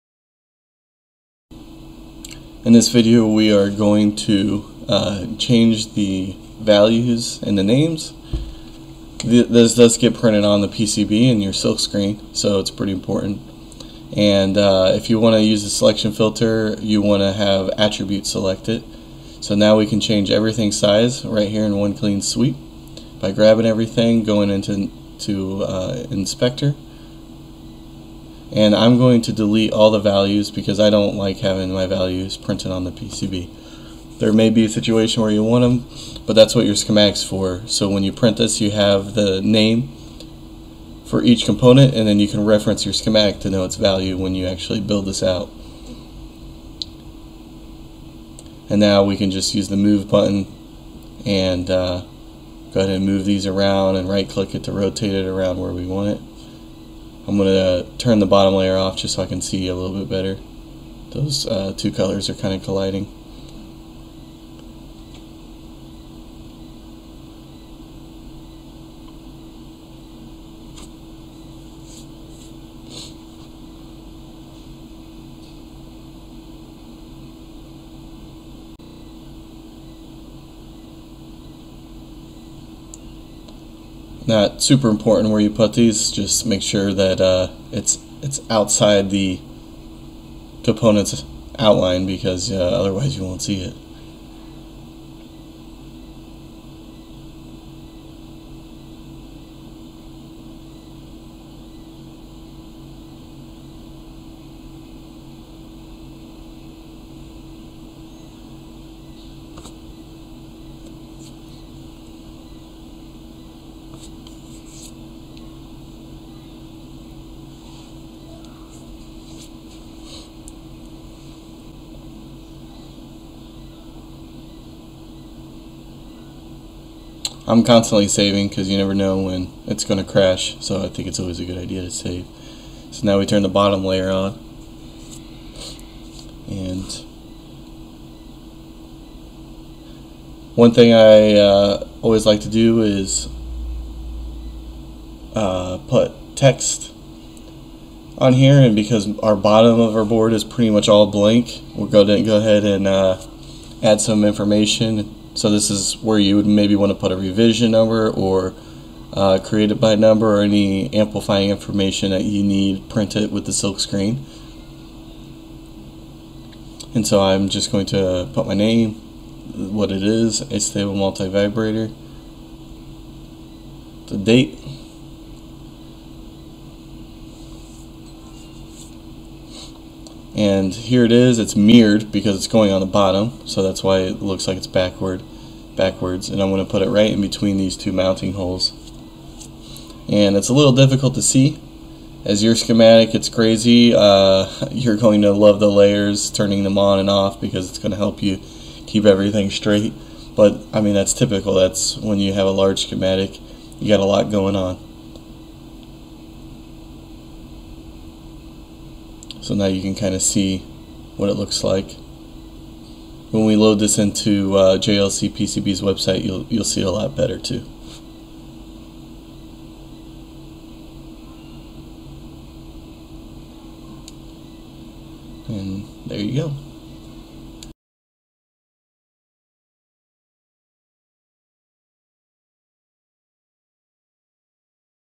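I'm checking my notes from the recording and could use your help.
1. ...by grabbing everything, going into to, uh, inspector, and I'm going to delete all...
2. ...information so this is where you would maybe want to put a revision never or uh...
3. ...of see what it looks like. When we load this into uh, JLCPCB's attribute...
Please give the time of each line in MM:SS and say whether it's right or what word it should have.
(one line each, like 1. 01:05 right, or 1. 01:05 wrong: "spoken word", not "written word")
1. 00:23 right
2. 02:34 wrong: "number", not "never"
3. 03:30 wrong: "website", not "attribute".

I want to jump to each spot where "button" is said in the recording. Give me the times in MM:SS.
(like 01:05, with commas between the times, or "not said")
00:50.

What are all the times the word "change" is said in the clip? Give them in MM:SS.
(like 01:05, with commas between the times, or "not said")
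00:05, 00:19.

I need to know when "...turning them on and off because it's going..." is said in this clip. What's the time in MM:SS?
03:16.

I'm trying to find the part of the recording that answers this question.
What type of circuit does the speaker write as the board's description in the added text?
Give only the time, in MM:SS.
02:50.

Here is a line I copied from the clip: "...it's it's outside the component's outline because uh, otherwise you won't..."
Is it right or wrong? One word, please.
right.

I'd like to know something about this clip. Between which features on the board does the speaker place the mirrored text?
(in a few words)
two mounting holes.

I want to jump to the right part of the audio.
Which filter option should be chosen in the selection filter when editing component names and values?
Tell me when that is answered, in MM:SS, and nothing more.
00:17.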